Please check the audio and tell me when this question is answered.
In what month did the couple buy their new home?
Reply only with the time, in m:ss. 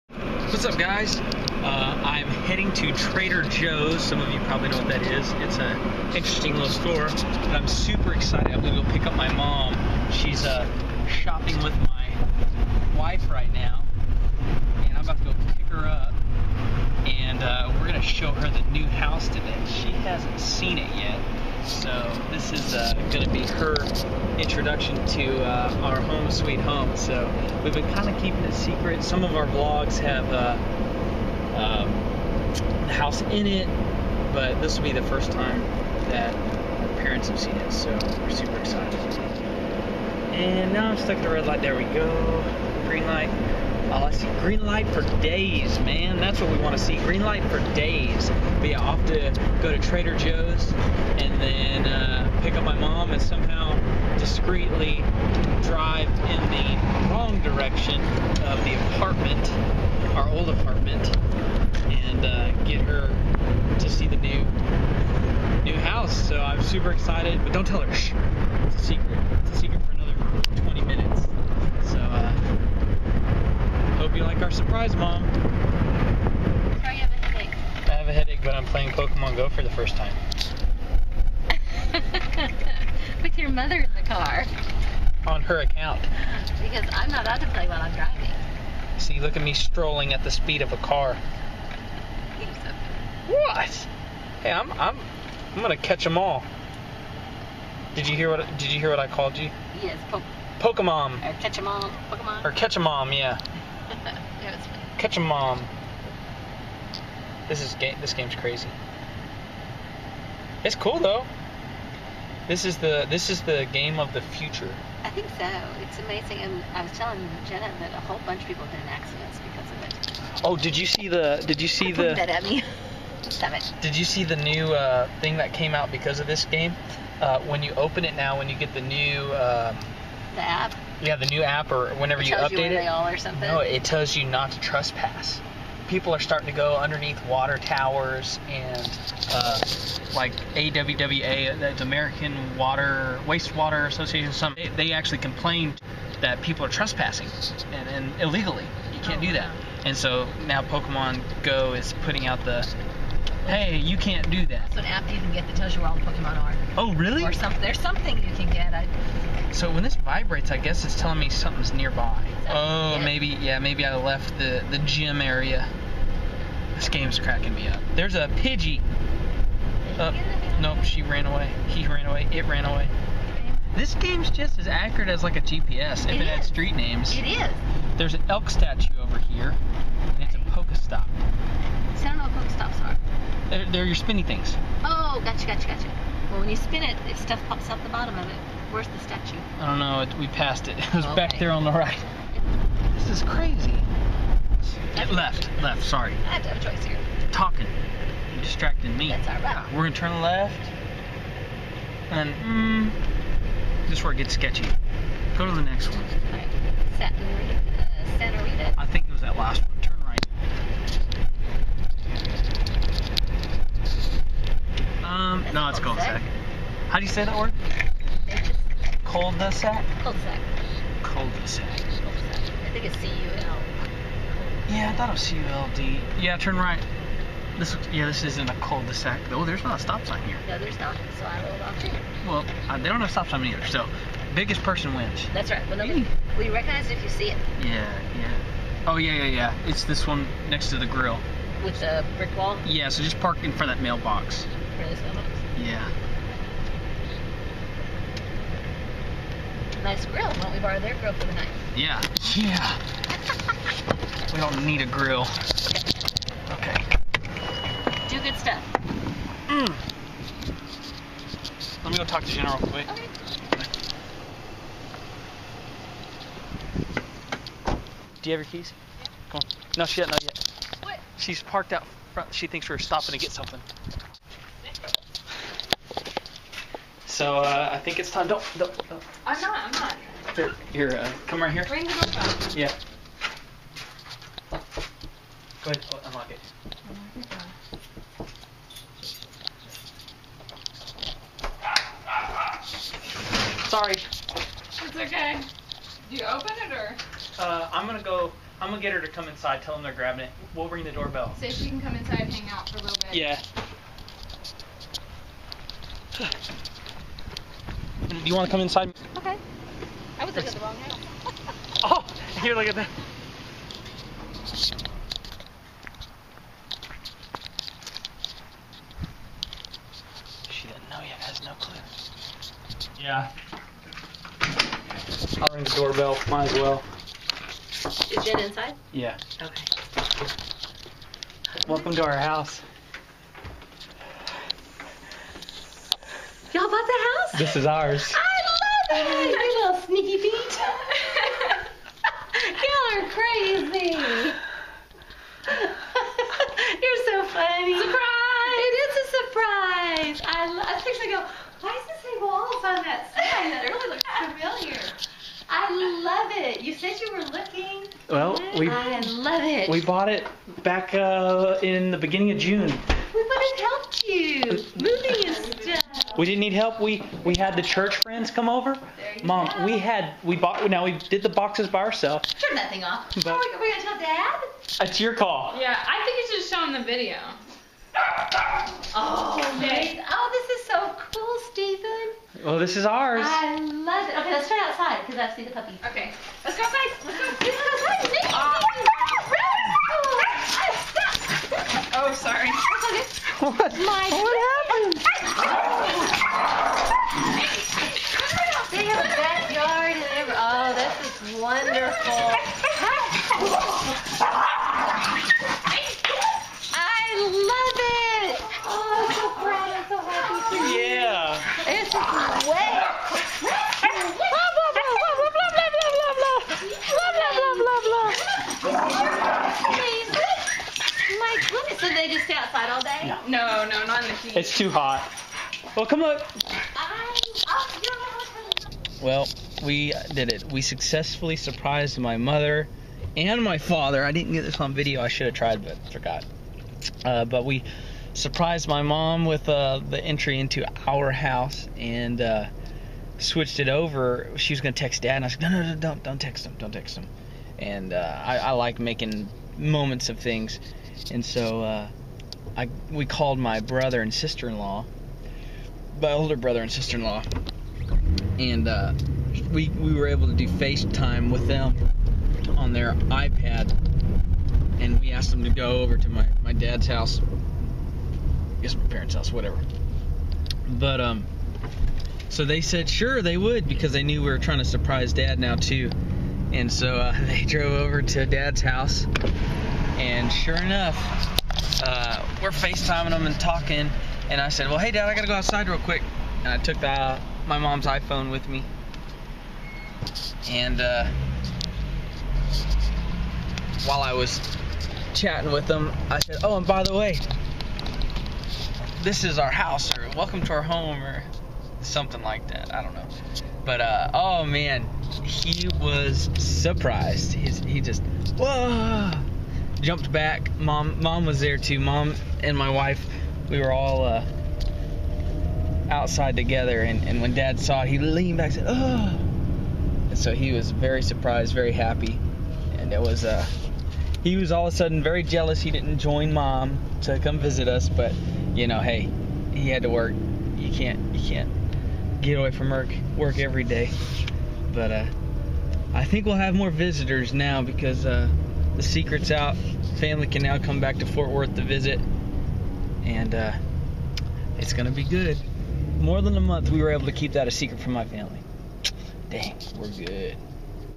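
6:02.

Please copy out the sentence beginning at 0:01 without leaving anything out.
Uh, I'm heading to Trader Joe's.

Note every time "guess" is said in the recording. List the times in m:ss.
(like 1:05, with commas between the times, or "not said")
2:40, 7:48.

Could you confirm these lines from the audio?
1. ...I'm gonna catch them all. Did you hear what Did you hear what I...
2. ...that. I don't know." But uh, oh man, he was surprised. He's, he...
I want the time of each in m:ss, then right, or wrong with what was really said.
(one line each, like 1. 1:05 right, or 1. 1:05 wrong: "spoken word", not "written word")
1. 1:35 right
2. 8:22 right.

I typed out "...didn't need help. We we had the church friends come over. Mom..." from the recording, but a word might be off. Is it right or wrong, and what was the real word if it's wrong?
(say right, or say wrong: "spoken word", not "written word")
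right.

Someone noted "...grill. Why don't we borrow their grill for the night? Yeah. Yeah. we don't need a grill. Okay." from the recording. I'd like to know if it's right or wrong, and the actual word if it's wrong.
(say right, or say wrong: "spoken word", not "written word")
right.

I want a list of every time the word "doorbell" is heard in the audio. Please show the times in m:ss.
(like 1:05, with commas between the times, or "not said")
4:41, 5:00, 5:25.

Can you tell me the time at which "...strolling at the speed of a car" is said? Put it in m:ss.
1:29.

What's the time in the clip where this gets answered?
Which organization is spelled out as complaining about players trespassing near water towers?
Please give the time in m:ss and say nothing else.
2:21.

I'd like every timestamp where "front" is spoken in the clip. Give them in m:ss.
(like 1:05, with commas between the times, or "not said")
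4:03, 4:32.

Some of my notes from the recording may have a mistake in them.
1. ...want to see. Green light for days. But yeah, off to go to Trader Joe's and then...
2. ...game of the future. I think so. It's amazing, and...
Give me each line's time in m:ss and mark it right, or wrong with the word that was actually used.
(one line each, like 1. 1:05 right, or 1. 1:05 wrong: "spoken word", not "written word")
1. 0:46 right
2. 1:53 right.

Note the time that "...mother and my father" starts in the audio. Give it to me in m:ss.
7:12.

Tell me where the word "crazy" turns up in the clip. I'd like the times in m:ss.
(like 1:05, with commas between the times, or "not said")
1:48, 3:13, 5:43.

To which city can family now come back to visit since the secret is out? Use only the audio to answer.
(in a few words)
Fort Worth.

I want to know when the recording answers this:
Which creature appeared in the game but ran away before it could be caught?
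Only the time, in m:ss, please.
2:48.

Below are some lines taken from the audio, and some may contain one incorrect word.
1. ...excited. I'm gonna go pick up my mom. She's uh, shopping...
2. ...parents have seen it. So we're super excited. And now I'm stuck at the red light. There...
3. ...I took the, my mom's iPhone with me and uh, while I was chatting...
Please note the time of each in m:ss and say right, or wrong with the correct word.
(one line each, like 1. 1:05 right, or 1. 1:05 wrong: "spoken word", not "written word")
1. 0:08 right
2. 0:36 right
3. 8:06 right.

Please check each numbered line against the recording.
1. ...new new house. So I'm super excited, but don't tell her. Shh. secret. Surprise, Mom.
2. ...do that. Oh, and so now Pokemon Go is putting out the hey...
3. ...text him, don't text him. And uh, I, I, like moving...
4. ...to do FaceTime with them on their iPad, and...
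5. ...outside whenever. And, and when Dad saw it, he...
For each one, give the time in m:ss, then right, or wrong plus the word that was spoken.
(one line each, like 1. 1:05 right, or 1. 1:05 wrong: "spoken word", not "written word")
1. 1:04 right
2. 2:29 right
3. 7:26 wrong: "making", not "moving"
4. 7:40 right
5. 8:35 wrong: "together", not "whenever".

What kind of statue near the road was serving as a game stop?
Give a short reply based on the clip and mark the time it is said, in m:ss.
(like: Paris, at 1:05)
Elk statue, at 2:58.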